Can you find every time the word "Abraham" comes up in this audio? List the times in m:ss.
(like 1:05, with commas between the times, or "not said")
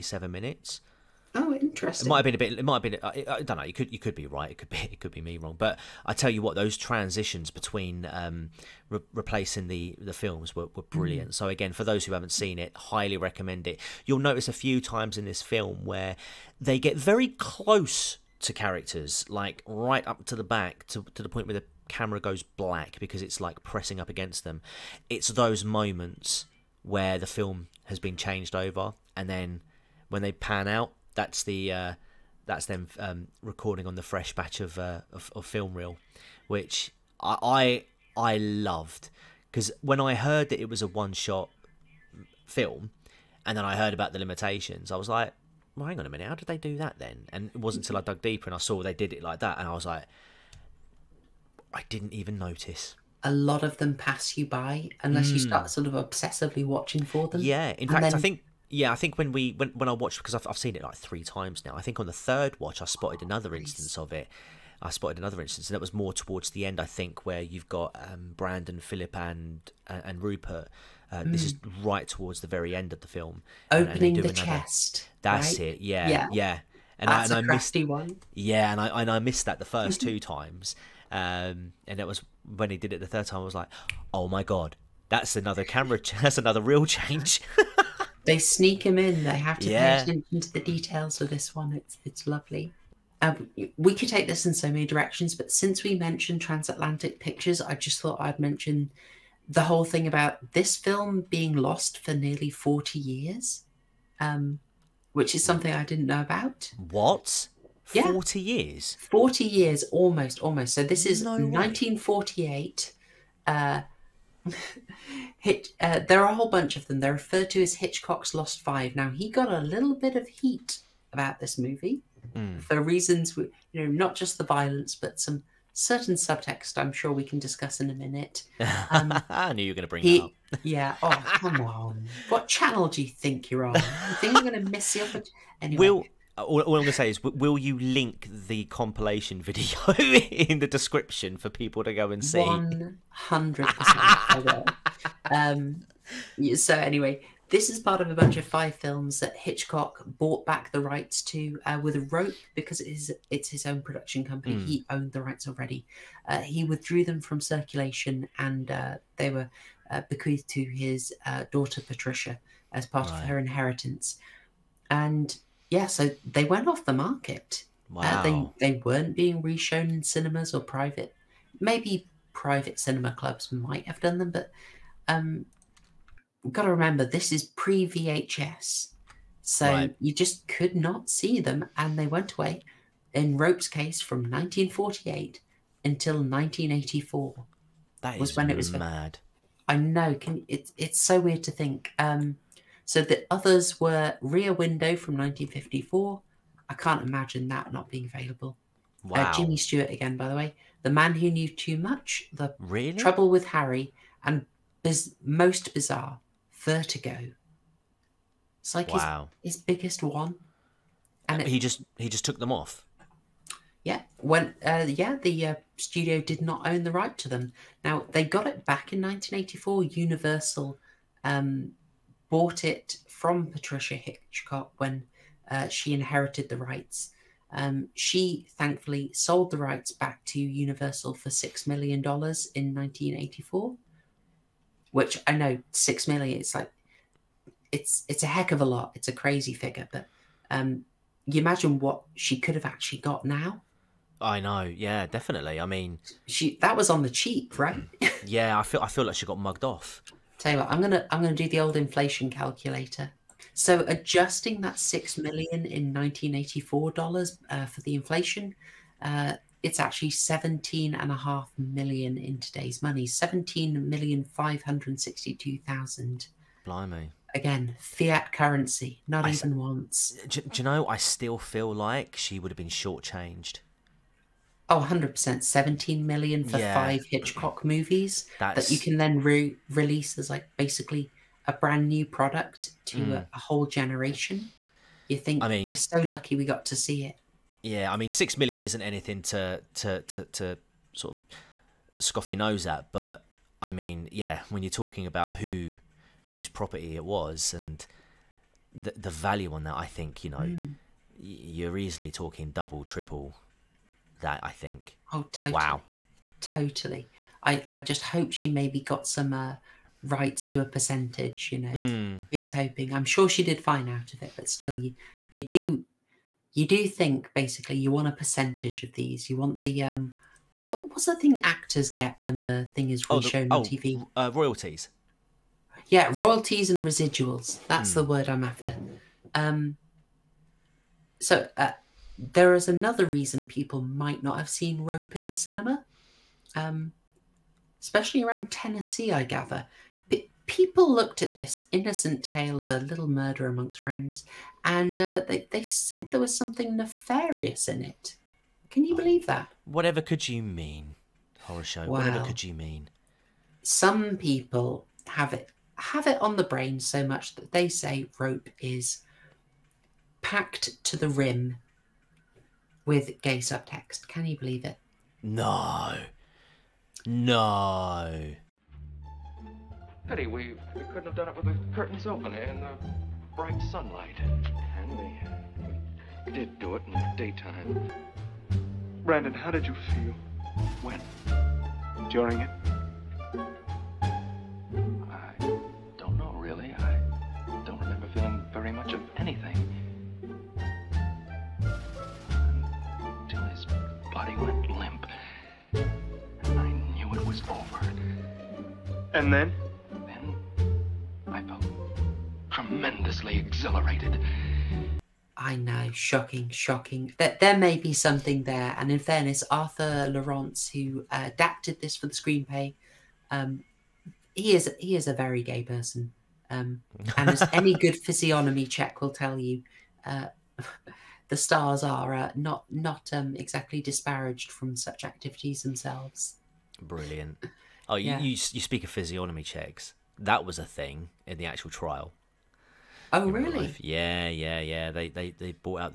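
not said.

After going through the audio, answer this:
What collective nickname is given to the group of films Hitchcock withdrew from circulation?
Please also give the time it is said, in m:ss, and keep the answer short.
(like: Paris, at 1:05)
Hitchcock's Lost Five, at 1:57.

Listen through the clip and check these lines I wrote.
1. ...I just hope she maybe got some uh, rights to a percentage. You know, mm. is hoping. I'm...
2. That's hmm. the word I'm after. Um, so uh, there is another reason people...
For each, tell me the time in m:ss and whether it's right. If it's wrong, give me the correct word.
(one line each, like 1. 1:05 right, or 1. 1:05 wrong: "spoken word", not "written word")
1. 5:07 right
2. 5:27 right.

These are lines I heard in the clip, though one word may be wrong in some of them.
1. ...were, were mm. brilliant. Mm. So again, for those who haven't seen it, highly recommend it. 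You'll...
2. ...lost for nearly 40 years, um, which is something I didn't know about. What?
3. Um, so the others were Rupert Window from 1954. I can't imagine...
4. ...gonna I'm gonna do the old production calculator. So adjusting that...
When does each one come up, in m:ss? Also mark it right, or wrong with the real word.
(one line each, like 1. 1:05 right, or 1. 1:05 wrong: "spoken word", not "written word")
1. 0:10 right
2. 1:41 right
3. 3:11 wrong: "Rear", not "Rupert"
4. 4:10 wrong: "inflation", not "production".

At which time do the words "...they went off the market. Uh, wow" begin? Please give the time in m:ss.
2:46.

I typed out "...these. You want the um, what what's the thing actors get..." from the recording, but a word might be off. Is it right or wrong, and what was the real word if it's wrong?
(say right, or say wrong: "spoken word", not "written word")
right.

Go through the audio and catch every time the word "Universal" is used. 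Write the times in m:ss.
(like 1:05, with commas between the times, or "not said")
3:39, 3:50.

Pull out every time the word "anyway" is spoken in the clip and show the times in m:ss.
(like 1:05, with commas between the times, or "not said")
2:15, 2:26.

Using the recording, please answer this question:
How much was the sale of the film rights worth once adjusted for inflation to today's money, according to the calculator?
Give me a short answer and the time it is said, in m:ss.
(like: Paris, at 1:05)
$17,562,000, at 4:23.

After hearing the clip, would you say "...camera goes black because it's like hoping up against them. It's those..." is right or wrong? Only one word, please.
wrong.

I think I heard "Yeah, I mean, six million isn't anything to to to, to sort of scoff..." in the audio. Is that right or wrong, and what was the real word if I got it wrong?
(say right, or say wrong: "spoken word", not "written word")
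right.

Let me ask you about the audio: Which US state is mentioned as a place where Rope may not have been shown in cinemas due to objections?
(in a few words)
Tennessee.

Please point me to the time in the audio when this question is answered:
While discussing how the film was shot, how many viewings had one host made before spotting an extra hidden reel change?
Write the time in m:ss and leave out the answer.
1:00.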